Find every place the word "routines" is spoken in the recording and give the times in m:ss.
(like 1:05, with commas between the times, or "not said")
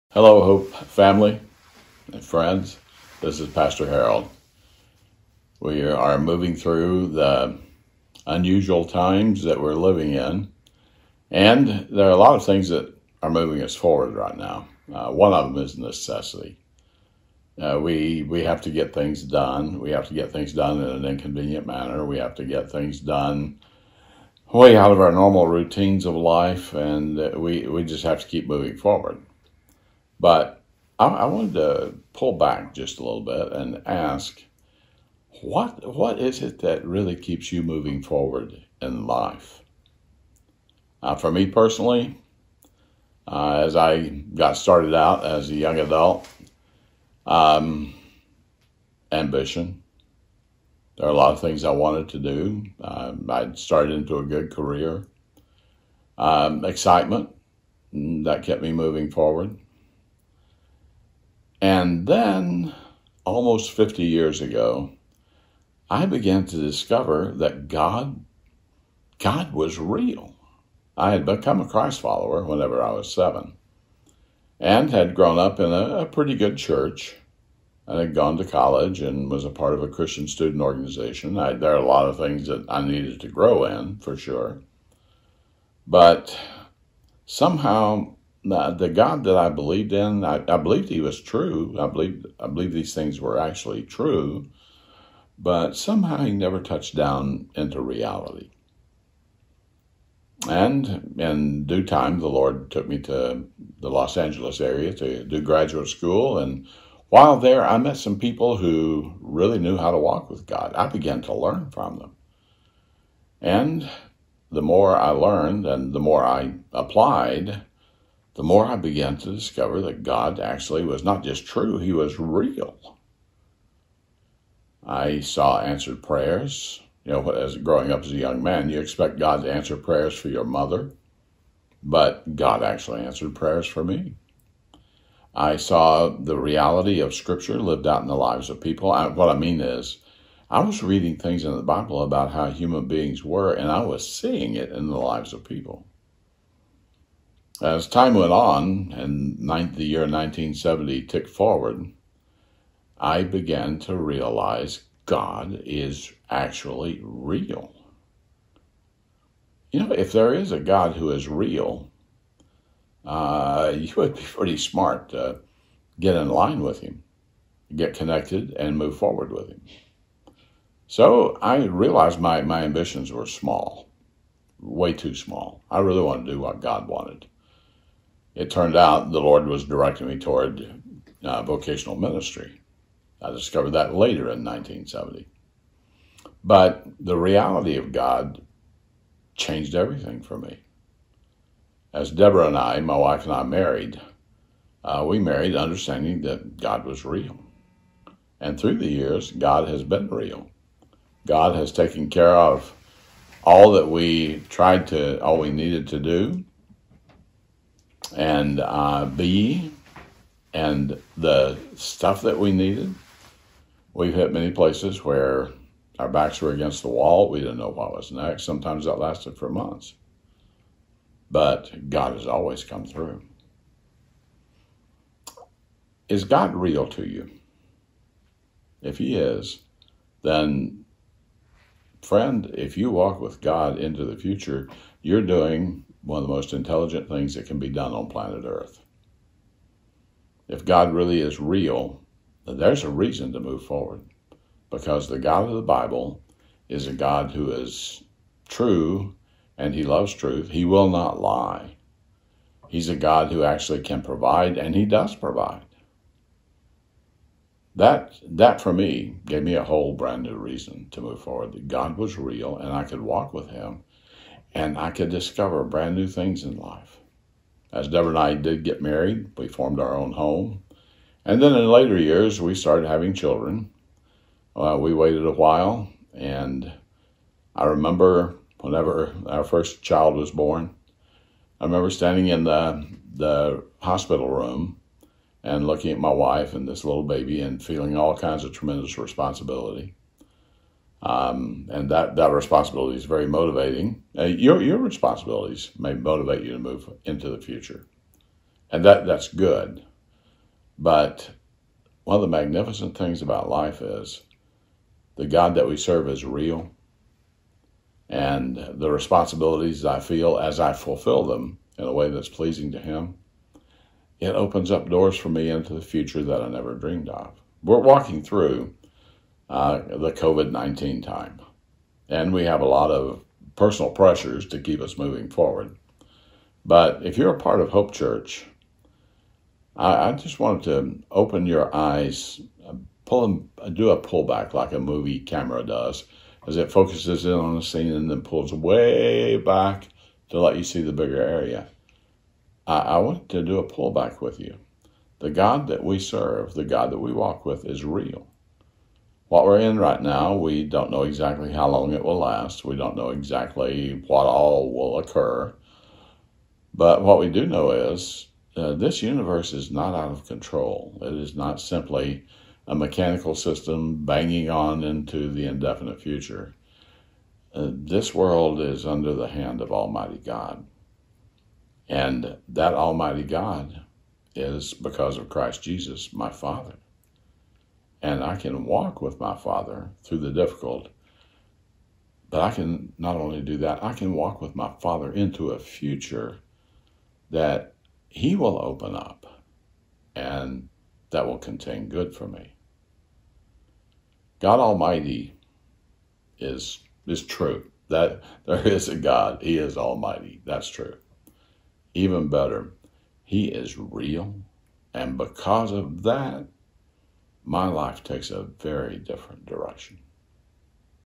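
0:25.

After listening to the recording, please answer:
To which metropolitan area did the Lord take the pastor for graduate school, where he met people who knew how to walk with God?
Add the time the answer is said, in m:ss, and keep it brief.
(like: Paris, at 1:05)
Los Angeles, at 1:43.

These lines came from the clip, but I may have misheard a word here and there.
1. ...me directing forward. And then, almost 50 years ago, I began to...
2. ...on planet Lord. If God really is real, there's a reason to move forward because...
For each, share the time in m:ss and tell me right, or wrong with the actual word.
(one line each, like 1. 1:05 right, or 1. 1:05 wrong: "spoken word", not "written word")
1. 0:58 wrong: "moving", not "directing"
2. 3:57 wrong: "Earth", not "Lord".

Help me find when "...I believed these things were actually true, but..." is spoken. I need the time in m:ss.
1:32.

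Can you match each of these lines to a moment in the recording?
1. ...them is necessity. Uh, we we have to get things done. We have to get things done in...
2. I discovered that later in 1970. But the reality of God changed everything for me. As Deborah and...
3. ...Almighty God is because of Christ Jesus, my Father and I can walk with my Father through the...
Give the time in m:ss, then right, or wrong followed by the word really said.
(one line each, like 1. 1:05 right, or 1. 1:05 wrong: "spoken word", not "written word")
1. 0:15 right
2. 3:03 right
3. 6:12 right.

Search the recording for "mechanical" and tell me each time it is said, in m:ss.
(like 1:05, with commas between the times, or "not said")
6:02.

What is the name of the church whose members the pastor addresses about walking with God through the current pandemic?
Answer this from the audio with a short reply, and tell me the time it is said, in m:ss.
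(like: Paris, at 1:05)
Hope Church, at 5:27.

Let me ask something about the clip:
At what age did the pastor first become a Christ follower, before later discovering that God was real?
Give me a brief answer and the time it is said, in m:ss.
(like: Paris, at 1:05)
7, at 1:13.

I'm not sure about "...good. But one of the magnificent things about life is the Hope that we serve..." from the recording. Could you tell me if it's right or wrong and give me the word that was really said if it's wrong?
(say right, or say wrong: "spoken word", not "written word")
wrong: "God", not "Hope".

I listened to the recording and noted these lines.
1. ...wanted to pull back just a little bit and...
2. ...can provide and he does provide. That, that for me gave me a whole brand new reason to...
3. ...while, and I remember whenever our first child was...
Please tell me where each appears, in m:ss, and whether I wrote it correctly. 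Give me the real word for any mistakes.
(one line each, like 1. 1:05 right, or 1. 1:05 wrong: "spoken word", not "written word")
1. 0:31 right
2. 4:13 right
3. 4:35 right.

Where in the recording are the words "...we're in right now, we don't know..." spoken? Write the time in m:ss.
5:49.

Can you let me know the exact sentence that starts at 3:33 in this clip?
We've hit many places where our backs were against the wall.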